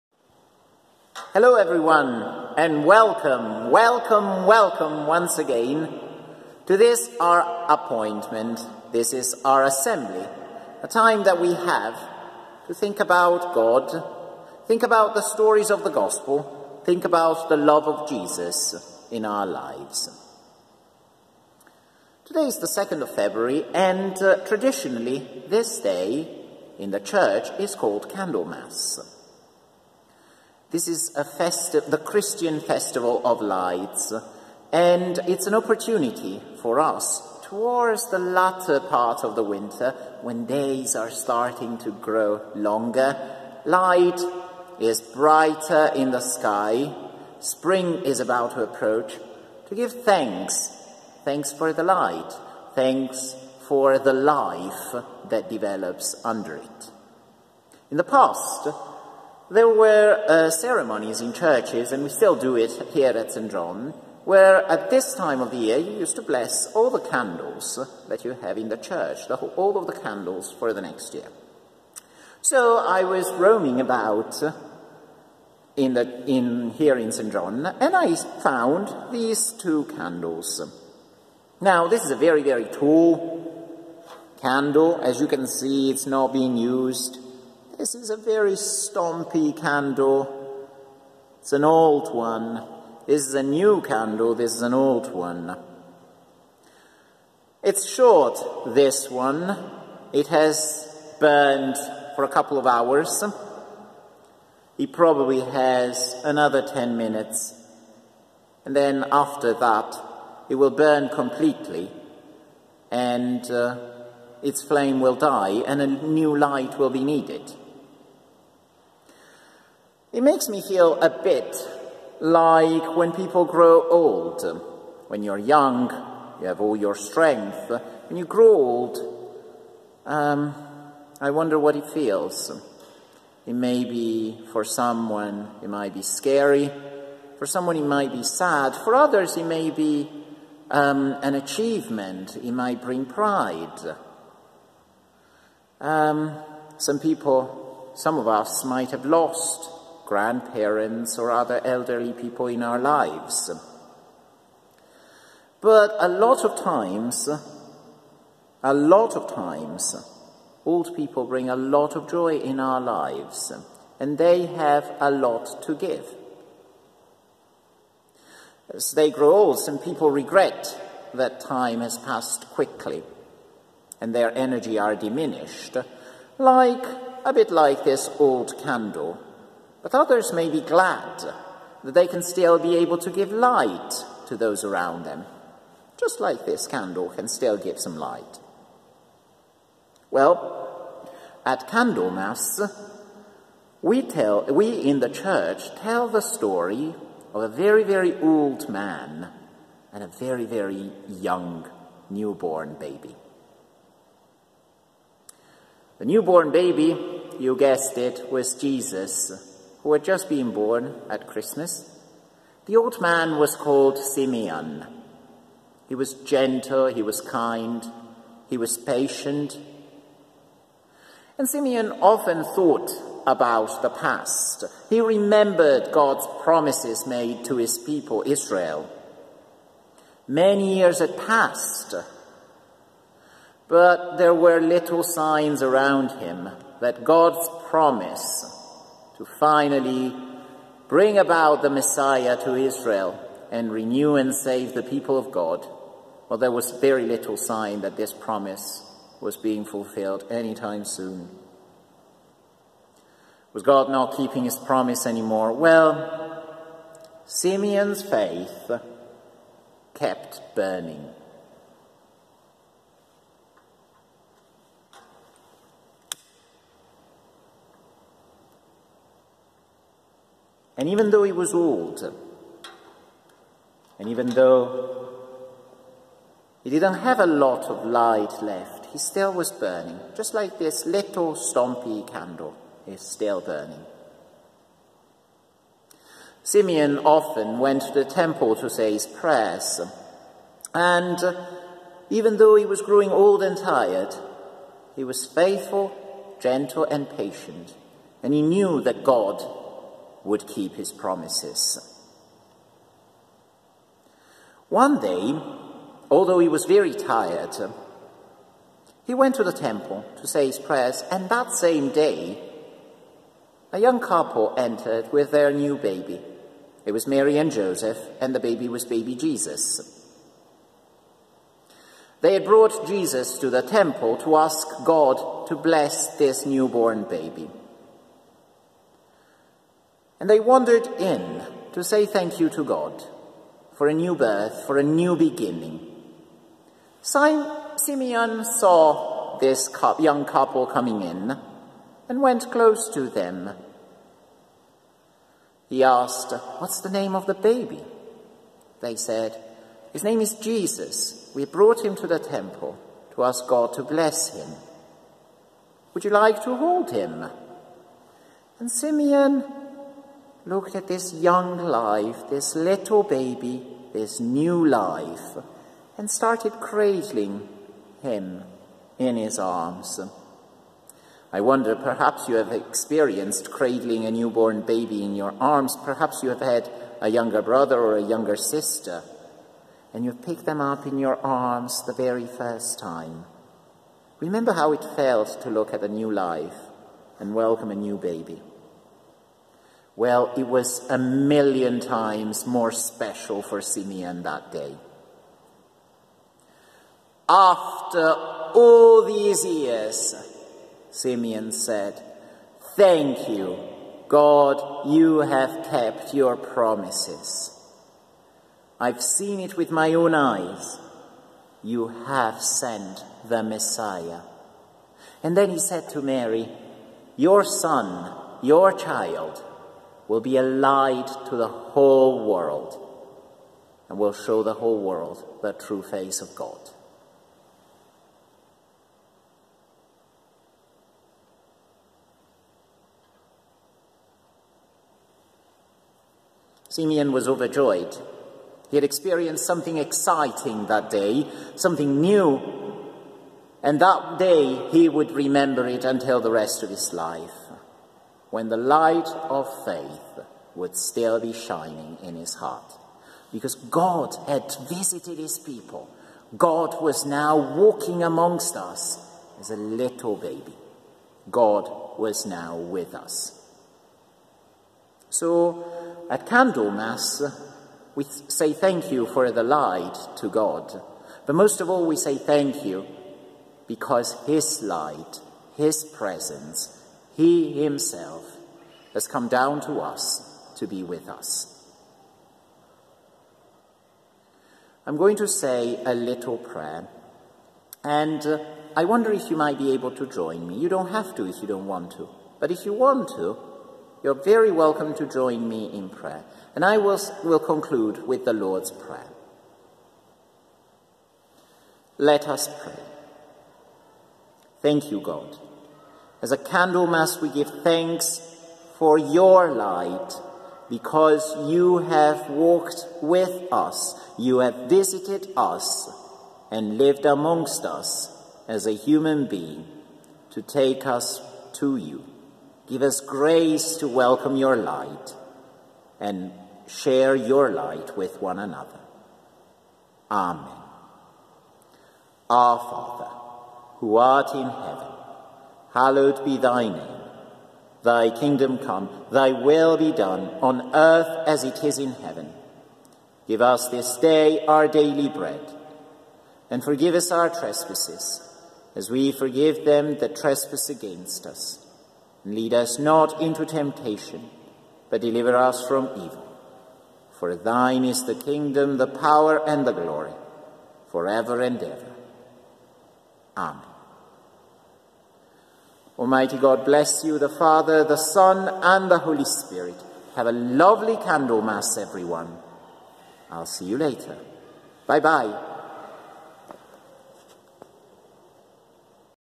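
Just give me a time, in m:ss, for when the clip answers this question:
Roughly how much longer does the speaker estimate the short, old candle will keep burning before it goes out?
1:46.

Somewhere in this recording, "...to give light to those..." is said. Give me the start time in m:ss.
3:02.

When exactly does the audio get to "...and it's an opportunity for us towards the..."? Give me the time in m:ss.
0:34.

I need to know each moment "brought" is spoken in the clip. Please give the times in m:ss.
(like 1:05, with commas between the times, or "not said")
5:22, 5:51.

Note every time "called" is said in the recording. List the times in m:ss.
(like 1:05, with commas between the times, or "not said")
0:27, 3:33.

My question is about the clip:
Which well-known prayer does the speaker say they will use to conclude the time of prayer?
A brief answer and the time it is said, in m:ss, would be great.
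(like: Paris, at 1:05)
The Lord's Prayer, at 8:18.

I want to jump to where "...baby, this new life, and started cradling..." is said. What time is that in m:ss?
6:03.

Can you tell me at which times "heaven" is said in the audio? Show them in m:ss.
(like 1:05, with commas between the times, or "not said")
8:54, 9:01.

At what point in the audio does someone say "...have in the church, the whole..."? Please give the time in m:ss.
1:08.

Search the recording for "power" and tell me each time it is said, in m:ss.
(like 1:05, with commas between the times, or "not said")
9:18.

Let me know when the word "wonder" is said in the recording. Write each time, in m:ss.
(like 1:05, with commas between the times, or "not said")
2:11, 6:11, 8:08.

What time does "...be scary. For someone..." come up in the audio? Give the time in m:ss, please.
2:15.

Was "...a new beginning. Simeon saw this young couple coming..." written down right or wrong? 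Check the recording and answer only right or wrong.
right.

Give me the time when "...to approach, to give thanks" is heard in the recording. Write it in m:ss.
0:48.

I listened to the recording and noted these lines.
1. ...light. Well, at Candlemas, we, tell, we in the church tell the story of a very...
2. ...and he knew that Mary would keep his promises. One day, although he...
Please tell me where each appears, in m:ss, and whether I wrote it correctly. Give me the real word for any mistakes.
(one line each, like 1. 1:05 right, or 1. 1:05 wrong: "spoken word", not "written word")
1. 3:07 right
2. 4:58 wrong: "God", not "Mary".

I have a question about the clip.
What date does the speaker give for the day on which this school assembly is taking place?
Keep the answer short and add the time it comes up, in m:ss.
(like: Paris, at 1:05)
2nd of February, at 0:22.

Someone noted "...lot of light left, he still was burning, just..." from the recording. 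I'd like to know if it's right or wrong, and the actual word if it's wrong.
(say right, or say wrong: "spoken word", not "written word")
right.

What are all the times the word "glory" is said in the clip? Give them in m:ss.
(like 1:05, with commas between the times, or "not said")
9:19.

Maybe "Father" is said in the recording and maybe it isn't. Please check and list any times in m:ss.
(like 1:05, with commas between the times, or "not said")
8:52, 9:27.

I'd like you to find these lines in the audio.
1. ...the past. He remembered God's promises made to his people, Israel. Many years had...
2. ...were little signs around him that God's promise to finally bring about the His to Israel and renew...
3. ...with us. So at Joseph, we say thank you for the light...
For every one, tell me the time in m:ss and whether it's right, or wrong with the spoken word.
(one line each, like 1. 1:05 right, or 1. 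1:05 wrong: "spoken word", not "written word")
1. 3:43 right
2. 3:54 wrong: "Messiah", not "His"
3. 7:42 wrong: "Candlemas", not "Joseph".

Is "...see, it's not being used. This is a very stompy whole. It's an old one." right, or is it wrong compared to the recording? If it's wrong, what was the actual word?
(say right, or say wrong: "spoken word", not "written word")
wrong: "candle", not "whole".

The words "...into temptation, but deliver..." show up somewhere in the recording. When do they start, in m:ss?
9:13.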